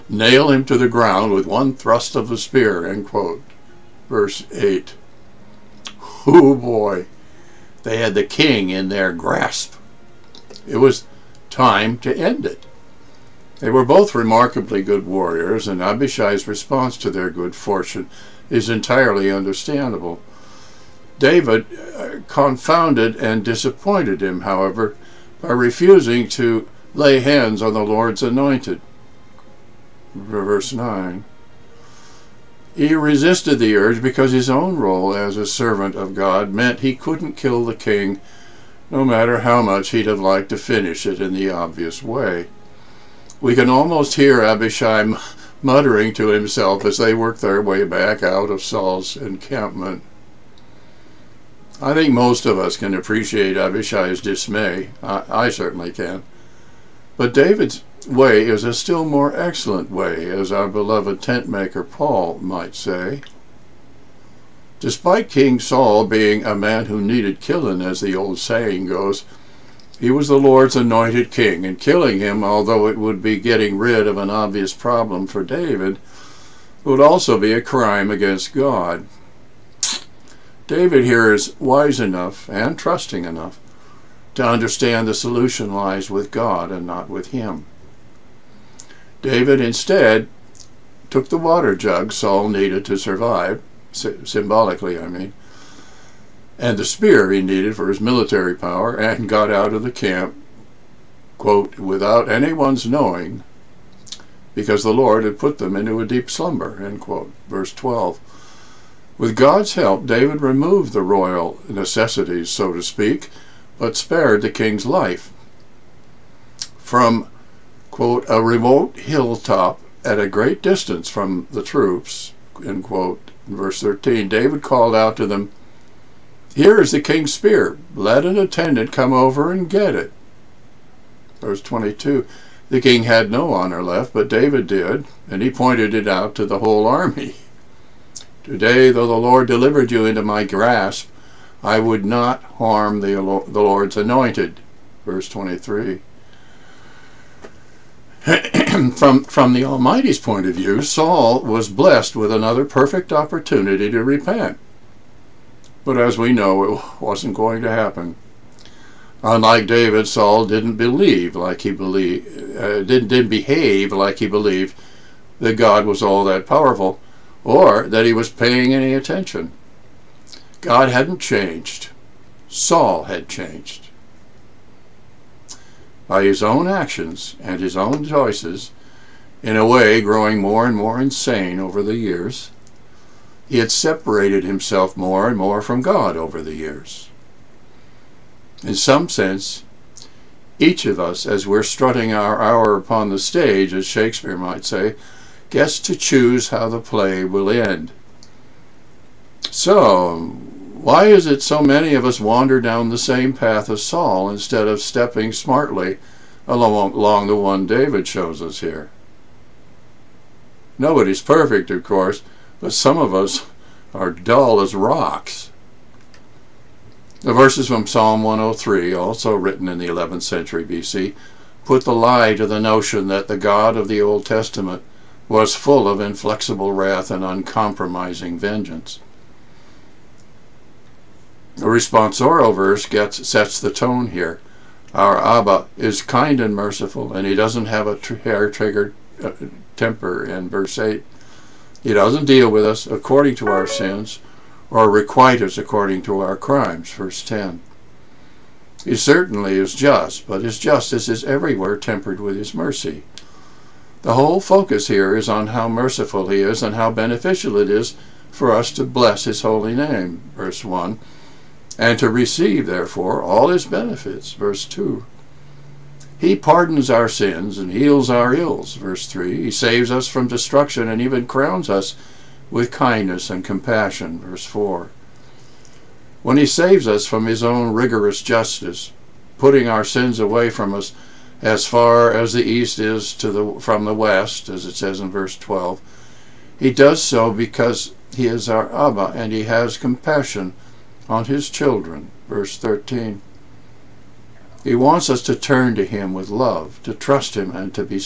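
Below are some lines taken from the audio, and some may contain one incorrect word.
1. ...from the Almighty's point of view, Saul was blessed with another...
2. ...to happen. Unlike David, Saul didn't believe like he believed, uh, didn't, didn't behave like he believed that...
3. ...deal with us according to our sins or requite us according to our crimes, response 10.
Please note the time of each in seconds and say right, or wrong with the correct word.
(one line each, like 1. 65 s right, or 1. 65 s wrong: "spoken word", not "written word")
1. 149 s right
2. 157 s right
3. 242 s wrong: "verse", not "response".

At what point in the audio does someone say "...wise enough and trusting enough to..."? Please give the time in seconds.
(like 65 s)
81 s.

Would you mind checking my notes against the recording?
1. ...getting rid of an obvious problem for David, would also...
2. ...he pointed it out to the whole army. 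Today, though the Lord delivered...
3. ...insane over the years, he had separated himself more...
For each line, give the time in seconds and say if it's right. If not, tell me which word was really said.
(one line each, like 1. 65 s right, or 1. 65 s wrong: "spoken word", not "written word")
1. 73 s right
2. 135 s right
3. 181 s right.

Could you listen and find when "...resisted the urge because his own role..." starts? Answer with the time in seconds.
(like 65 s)
32 s.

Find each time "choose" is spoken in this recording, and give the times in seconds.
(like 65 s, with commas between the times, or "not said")
195 s.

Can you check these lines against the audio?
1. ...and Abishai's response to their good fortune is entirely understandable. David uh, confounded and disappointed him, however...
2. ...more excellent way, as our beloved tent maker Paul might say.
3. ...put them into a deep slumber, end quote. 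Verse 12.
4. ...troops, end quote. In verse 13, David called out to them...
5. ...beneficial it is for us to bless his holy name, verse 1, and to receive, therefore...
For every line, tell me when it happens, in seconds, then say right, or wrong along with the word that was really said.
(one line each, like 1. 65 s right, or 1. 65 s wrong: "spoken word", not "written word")
1. 15 s right
2. 59 s right
3. 105 s right
4. 121 s right
5. 256 s right.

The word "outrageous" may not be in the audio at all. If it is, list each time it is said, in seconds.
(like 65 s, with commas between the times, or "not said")
not said.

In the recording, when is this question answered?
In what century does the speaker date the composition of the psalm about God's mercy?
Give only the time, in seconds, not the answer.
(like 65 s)
219 s.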